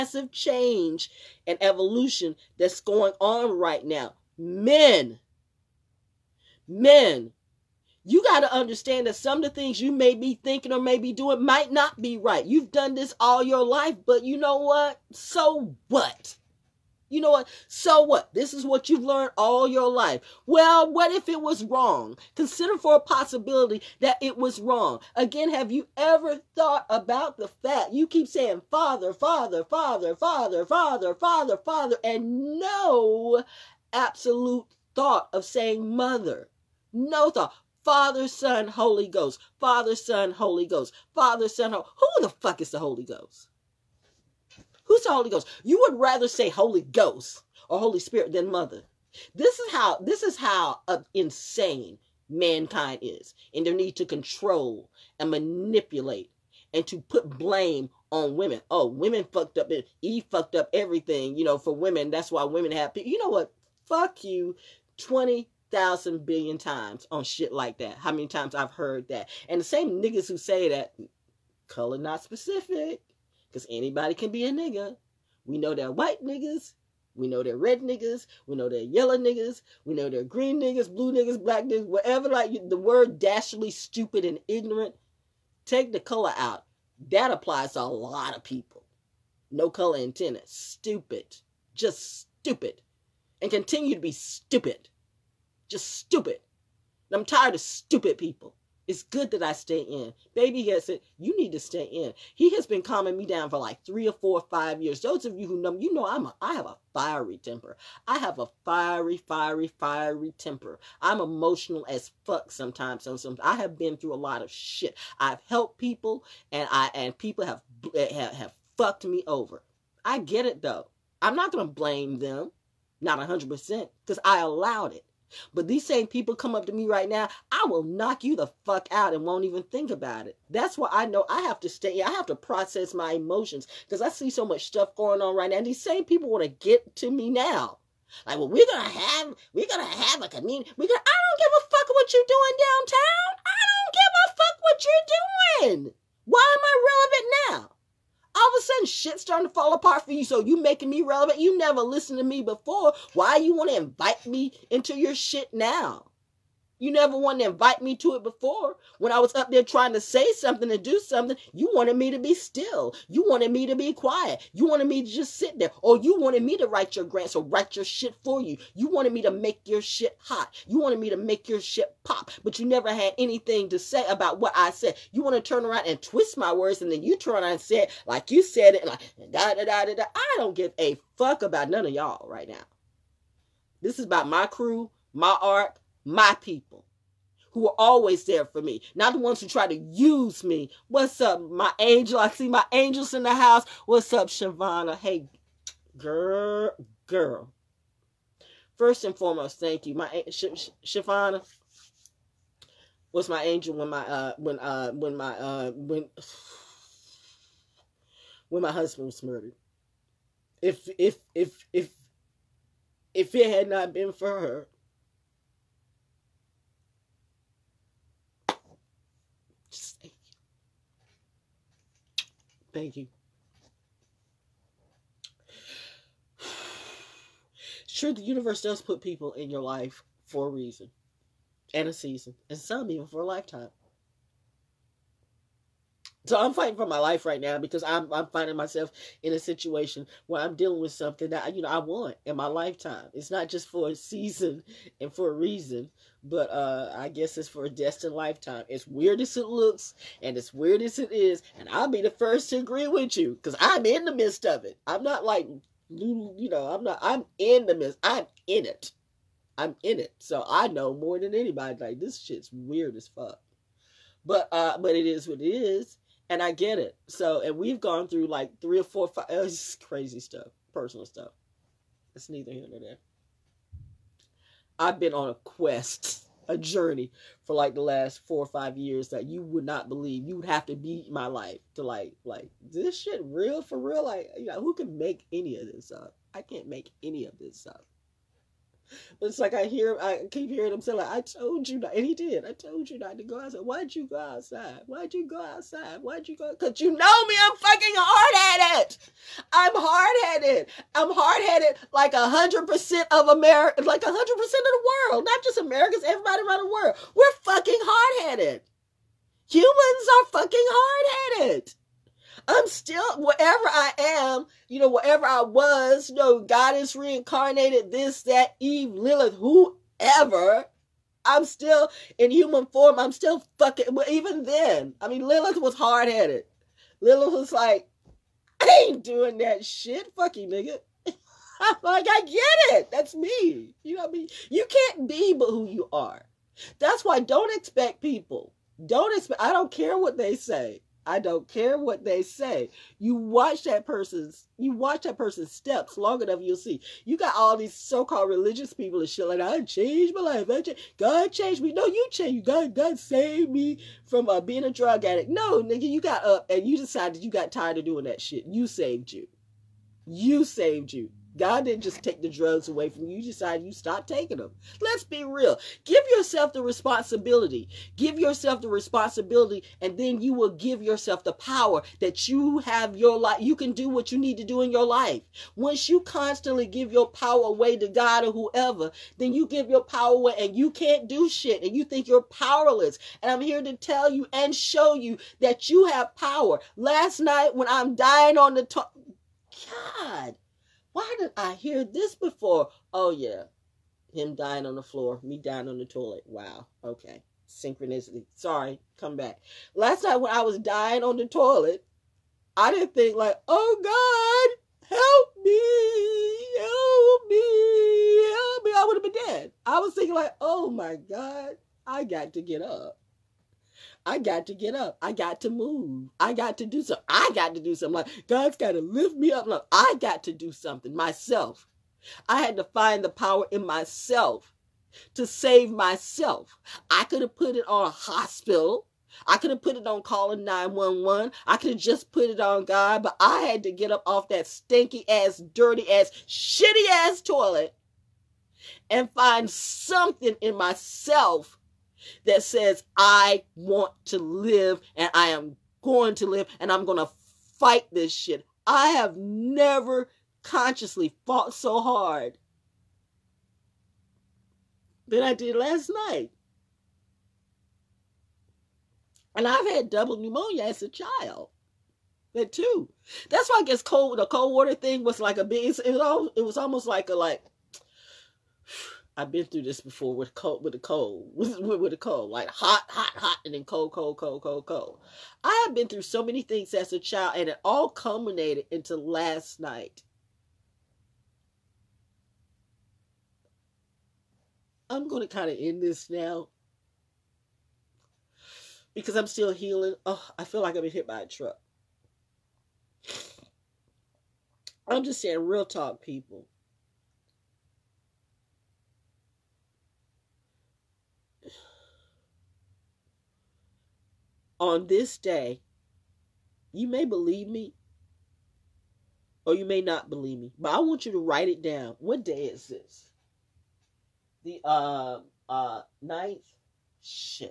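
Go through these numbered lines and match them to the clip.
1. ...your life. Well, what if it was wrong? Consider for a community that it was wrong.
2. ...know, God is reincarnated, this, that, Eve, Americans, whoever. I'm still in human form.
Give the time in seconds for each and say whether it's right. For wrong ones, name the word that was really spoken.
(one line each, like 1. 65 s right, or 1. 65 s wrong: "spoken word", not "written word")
1. 19 s wrong: "possibility", not "community"
2. 316 s wrong: "Lilith", not "Americans".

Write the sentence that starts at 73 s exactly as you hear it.
Because anybody can be a nigga.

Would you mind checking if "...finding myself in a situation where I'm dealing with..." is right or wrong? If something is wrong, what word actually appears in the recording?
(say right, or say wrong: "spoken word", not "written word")
right.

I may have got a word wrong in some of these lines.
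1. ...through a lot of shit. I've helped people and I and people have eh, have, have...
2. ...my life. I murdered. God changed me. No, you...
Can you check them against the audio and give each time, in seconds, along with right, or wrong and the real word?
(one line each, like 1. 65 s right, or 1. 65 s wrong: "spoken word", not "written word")
1. 113 s right
2. 350 s wrong: "changed", not "murdered".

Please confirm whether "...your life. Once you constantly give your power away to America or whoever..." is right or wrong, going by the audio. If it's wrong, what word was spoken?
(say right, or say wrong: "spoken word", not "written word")
wrong: "God", not "America".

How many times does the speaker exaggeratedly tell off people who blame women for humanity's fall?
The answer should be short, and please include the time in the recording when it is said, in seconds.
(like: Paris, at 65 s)
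20,000 billion, at 64 s.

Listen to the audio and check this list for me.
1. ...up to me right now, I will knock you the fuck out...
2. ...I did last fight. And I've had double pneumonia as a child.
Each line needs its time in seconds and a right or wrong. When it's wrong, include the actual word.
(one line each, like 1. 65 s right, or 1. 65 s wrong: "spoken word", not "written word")
1. 126 s right
2. 455 s wrong: "night", not "fight".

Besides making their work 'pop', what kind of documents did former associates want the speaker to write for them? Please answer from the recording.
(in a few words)
grants.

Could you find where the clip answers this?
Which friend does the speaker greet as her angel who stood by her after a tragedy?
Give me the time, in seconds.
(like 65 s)
194 s.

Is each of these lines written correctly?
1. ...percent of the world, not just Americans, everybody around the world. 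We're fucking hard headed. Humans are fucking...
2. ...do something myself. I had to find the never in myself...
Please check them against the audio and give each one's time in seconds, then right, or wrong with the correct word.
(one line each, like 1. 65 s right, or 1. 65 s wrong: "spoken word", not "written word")
1. 304 s right
2. 420 s wrong: "power", not "never".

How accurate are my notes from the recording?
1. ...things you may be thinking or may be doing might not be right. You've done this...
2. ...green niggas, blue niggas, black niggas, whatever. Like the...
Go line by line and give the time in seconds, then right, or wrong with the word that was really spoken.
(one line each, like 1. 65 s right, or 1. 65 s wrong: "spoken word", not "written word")
1. 9 s right
2. 80 s right.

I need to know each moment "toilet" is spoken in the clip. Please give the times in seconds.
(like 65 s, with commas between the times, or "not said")
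395 s, 401 s, 437 s.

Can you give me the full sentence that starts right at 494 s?
I'm just saying, real talk, people.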